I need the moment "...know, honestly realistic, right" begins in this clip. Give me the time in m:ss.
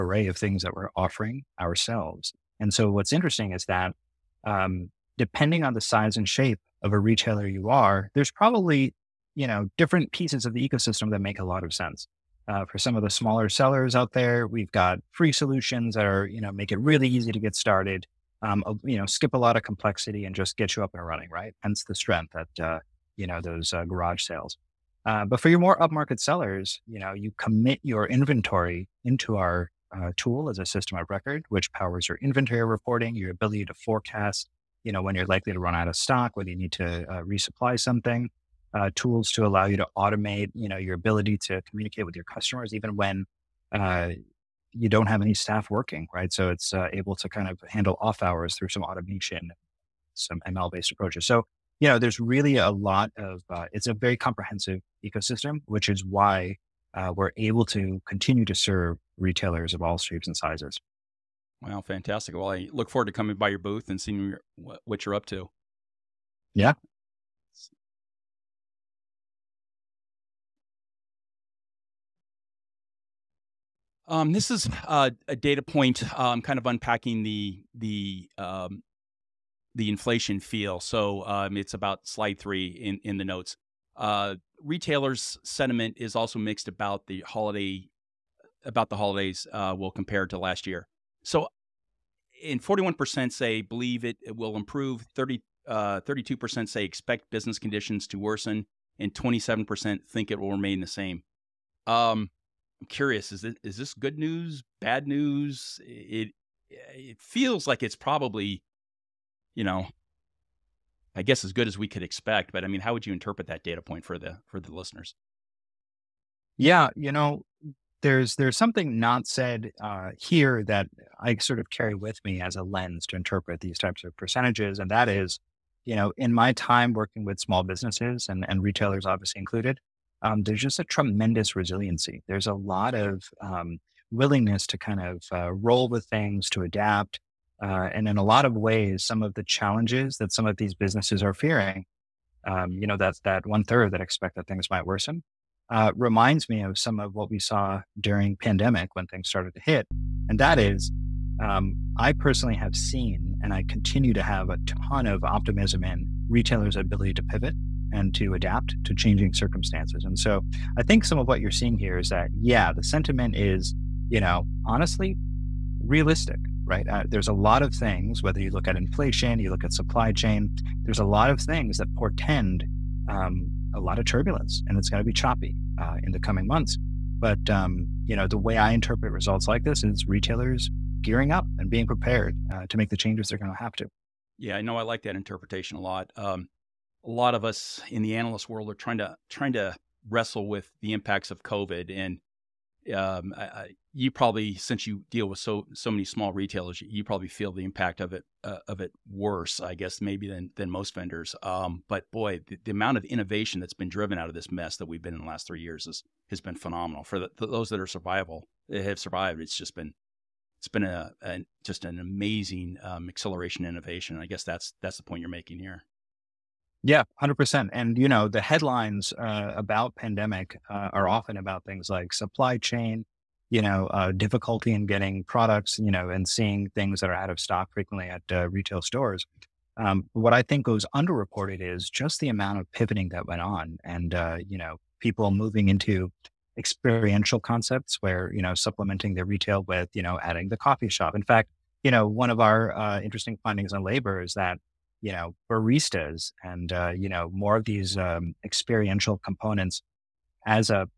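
2:44.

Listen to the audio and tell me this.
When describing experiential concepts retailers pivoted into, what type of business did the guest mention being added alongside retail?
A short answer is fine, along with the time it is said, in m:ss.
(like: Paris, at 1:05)
coffee shop, at 4:00.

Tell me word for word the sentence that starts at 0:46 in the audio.
So it's uh, able to kind of handle off hours through some automation, some ML based approaches.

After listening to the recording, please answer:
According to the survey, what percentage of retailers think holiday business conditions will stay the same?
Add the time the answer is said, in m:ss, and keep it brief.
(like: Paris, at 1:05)
27%, at 1:39.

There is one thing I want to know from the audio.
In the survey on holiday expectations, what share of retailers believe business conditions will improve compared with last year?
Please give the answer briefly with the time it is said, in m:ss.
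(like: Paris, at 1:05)
41%, at 1:32.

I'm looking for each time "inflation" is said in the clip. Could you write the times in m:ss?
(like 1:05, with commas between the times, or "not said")
1:19, 2:48.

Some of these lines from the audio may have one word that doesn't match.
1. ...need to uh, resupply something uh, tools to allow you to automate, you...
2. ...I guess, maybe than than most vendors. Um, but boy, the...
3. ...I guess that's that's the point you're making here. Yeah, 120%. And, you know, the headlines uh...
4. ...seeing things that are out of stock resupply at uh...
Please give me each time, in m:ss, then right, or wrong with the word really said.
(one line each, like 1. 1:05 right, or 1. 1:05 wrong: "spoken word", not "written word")
1. 0:36 right
2. 3:19 right
3. 3:34 wrong: "100", not "120"
4. 3:46 wrong: "frequently", not "resupply".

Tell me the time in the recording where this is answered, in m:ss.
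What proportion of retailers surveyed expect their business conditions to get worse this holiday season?
1:36.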